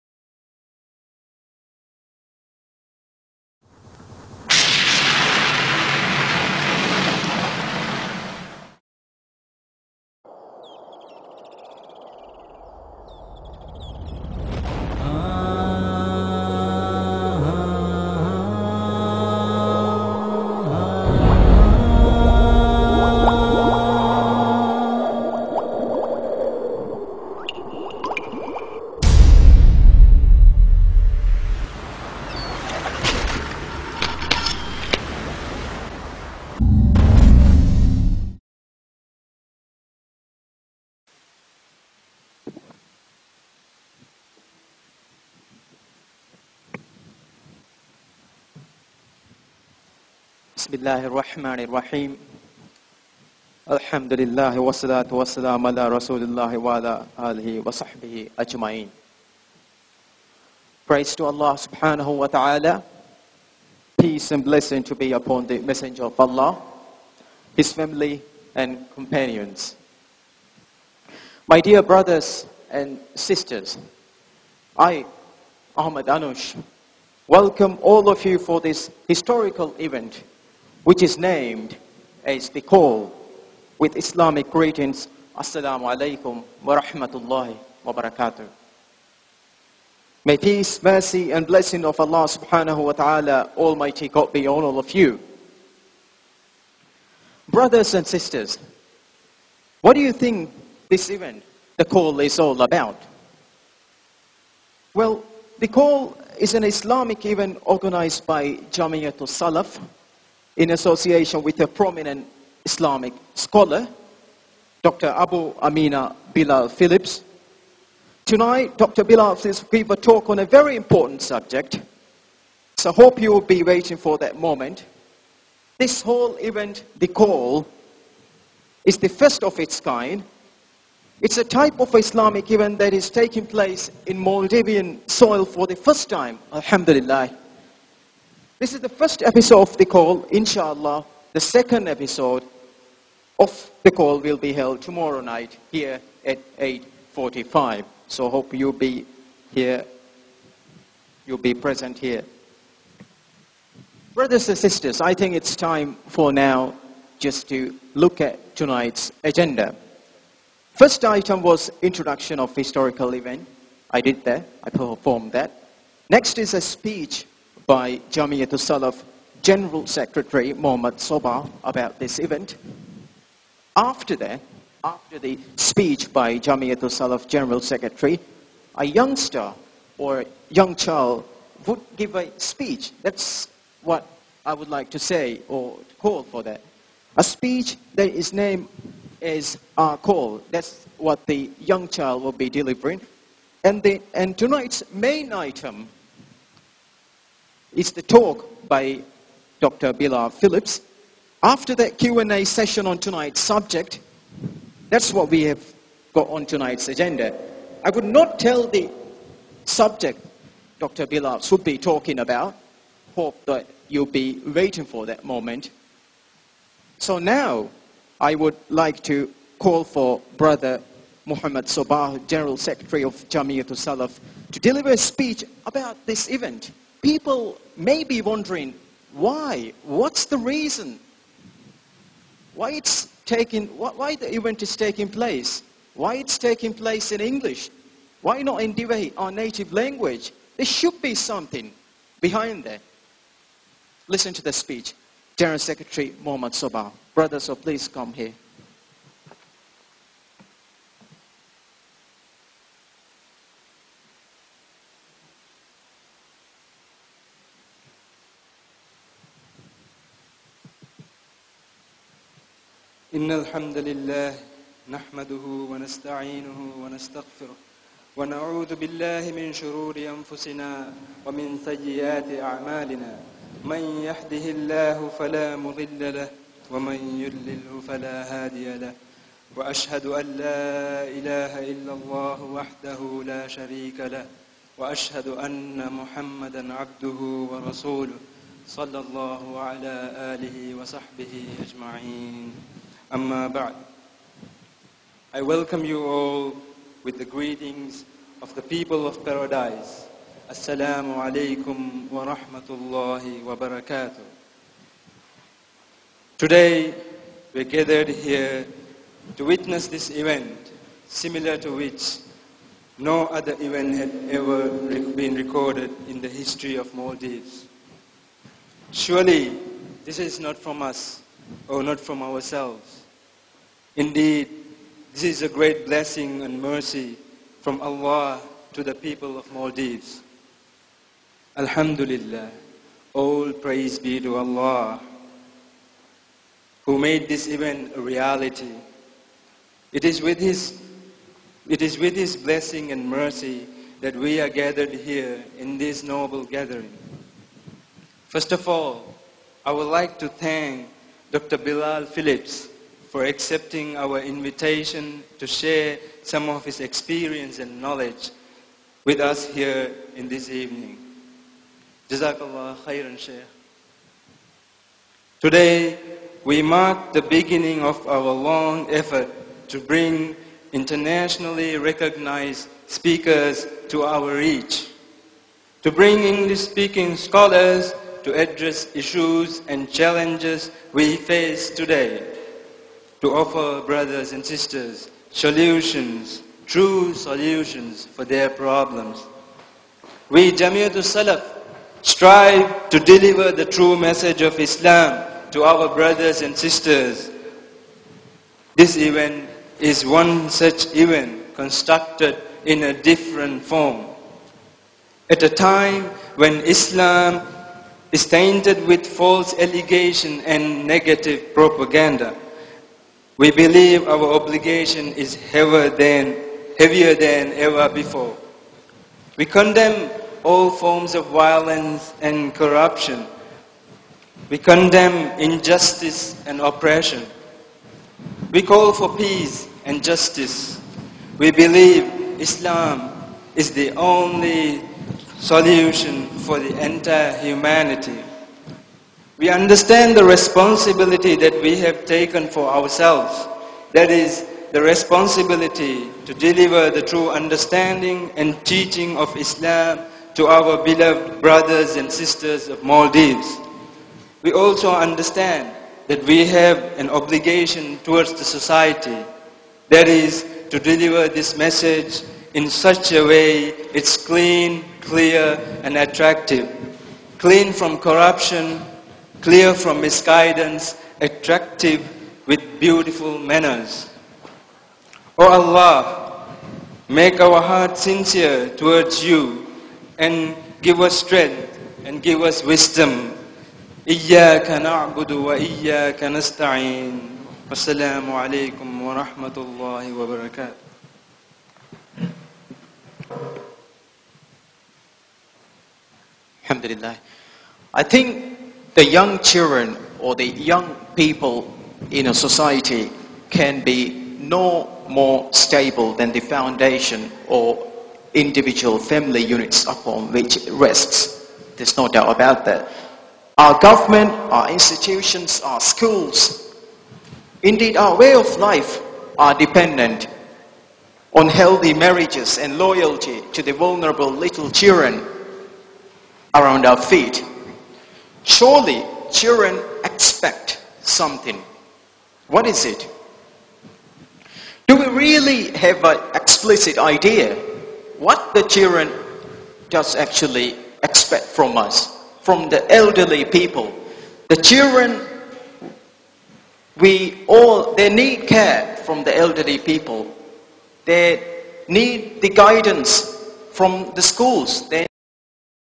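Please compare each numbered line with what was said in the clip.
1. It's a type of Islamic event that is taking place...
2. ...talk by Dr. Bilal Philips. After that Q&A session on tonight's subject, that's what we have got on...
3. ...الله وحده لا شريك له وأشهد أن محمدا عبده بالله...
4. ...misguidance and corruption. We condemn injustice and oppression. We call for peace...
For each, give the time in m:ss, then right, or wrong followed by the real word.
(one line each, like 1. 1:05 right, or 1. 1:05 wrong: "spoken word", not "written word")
1. 2:11 right
2. 3:18 right
3. 4:41 wrong: "ورسوله", not "بالله"
4. 7:01 wrong: "violence", not "misguidance".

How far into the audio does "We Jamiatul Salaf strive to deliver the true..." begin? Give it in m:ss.
6:30.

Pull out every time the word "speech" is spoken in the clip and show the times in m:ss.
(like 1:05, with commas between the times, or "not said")
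2:46, 2:55, 3:02, 3:07, 3:44, 4:04.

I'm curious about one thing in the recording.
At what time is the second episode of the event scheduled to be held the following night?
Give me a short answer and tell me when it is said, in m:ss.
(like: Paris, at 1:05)
8.45, at 2:26.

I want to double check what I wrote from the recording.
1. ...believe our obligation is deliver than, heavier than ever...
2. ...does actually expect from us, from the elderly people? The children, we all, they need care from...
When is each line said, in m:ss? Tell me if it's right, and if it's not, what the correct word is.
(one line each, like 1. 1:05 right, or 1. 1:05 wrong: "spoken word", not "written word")
1. 6:53 wrong: "heavier", not "deliver"
2. 8:59 right.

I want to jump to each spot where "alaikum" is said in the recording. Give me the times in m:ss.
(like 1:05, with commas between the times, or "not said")
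1:25, 5:01.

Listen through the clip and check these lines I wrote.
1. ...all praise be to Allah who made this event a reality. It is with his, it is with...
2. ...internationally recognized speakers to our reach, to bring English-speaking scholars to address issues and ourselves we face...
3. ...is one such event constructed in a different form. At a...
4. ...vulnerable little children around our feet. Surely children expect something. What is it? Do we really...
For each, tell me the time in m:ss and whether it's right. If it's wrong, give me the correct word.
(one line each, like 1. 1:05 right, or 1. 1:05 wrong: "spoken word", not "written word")
1. 5:33 right
2. 6:10 wrong: "challenges", not "ourselves"
3. 6:39 right
4. 8:43 right.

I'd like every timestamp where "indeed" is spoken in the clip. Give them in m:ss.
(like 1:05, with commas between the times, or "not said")
5:23, 8:37.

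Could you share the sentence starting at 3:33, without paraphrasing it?
Hope that you'll be waiting for that moment.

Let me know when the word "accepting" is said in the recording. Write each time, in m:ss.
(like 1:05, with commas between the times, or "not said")
5:53.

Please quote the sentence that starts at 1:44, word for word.
Well, the call is an Islamic event organized by Jamiatul Salaf, in association with a prominent Islamic scholar, Dr.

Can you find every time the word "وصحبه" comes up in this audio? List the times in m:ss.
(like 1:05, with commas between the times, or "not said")
0:57, 4:50.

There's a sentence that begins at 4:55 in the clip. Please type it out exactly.
I welcome you all with the greetings of the people of paradise.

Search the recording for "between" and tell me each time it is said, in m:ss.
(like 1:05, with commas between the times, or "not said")
not said.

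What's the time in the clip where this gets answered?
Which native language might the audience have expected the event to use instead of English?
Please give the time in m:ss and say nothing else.
3:58.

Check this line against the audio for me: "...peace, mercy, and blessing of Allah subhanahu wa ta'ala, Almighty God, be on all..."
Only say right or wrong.
right.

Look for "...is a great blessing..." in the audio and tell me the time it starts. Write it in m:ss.
5:25.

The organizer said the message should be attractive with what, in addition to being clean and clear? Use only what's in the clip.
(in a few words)
Beautiful manners.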